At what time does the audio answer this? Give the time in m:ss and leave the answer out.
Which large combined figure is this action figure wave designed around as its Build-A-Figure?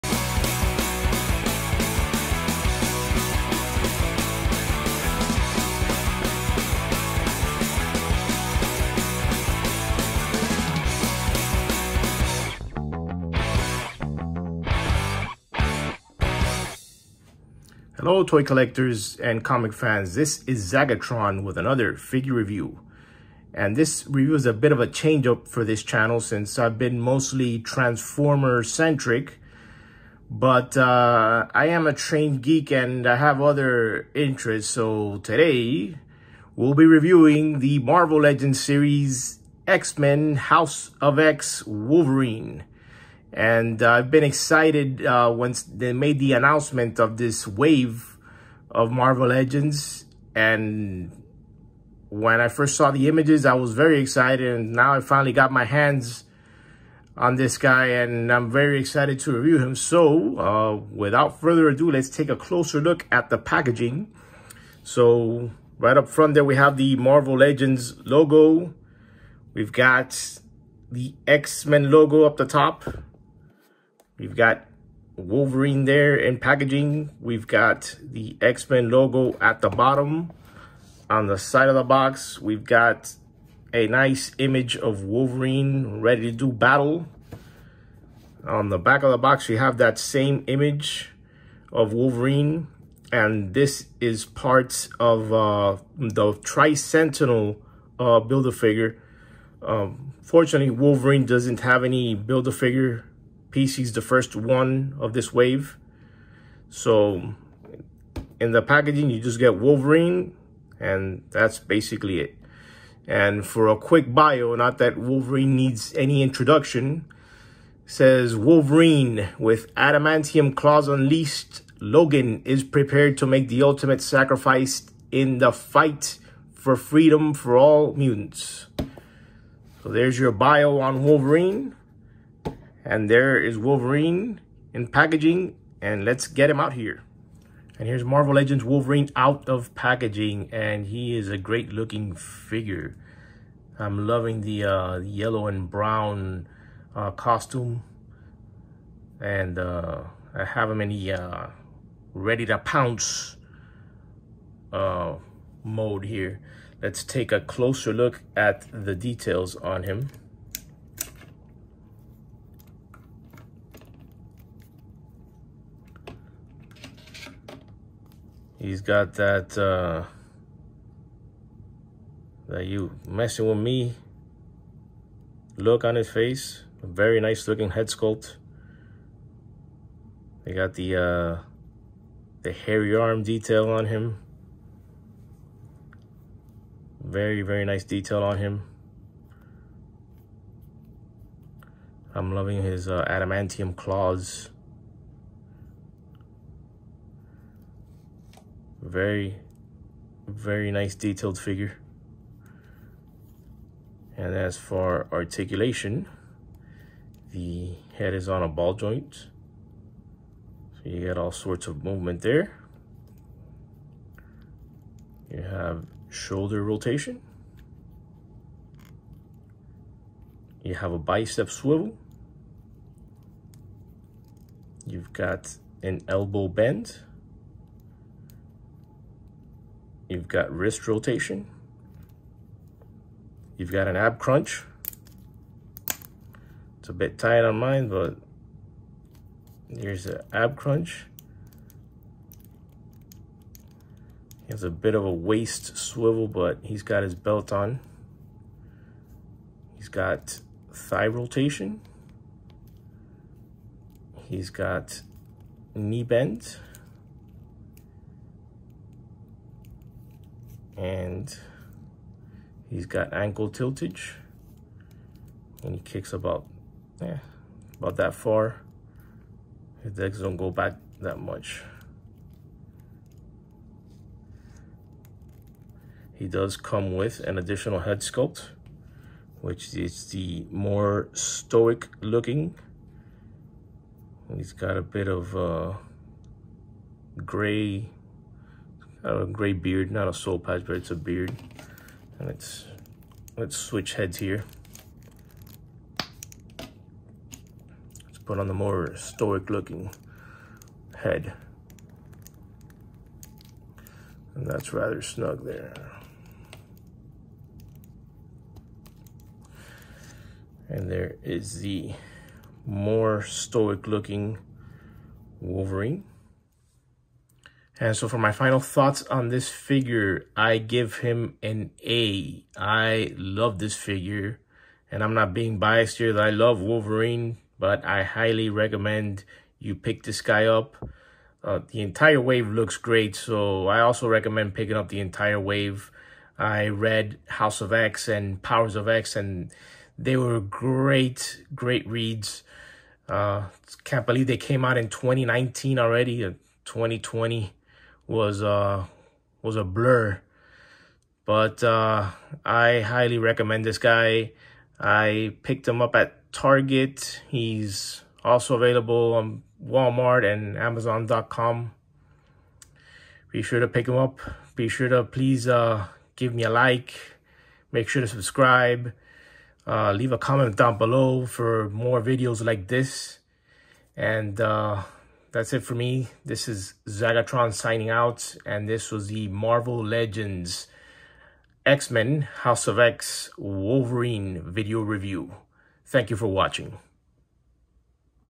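1:36.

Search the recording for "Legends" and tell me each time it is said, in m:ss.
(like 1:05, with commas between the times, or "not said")
0:38, 0:49, 1:07, 2:18, 6:19.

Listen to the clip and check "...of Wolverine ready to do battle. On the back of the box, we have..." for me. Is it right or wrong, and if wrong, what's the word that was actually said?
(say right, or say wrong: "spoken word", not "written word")
right.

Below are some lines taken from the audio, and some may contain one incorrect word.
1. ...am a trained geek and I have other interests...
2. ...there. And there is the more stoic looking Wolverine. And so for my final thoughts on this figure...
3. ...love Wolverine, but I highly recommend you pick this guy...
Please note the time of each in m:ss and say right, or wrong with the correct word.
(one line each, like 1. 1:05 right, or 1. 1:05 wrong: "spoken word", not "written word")
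1. 0:31 right
2. 5:05 right
3. 5:26 right.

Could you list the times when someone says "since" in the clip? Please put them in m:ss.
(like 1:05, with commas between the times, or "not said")
0:26.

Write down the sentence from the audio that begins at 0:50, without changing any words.
And when I first saw the images, I was very excited.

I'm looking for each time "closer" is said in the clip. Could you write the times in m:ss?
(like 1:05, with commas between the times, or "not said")
1:02, 2:37.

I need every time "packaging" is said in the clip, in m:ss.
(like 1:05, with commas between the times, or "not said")
1:03, 1:16, 1:48, 2:14, 2:19.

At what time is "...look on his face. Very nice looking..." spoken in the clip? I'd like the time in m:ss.
2:55.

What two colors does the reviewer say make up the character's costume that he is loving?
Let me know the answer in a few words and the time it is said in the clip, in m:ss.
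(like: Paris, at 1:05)
yellow and brown, at 2:24.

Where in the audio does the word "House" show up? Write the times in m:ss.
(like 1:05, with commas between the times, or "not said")
0:40, 5:37, 6:22.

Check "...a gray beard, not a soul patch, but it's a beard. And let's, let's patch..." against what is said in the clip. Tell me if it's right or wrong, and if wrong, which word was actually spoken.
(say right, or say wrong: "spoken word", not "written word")
wrong: "switch", not "patch".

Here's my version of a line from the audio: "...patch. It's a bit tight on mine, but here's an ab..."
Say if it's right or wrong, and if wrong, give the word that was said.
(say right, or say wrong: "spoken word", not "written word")
wrong: "crunch", not "patch".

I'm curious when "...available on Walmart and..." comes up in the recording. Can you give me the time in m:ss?
5:58.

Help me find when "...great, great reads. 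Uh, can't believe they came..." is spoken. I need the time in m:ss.
5:40.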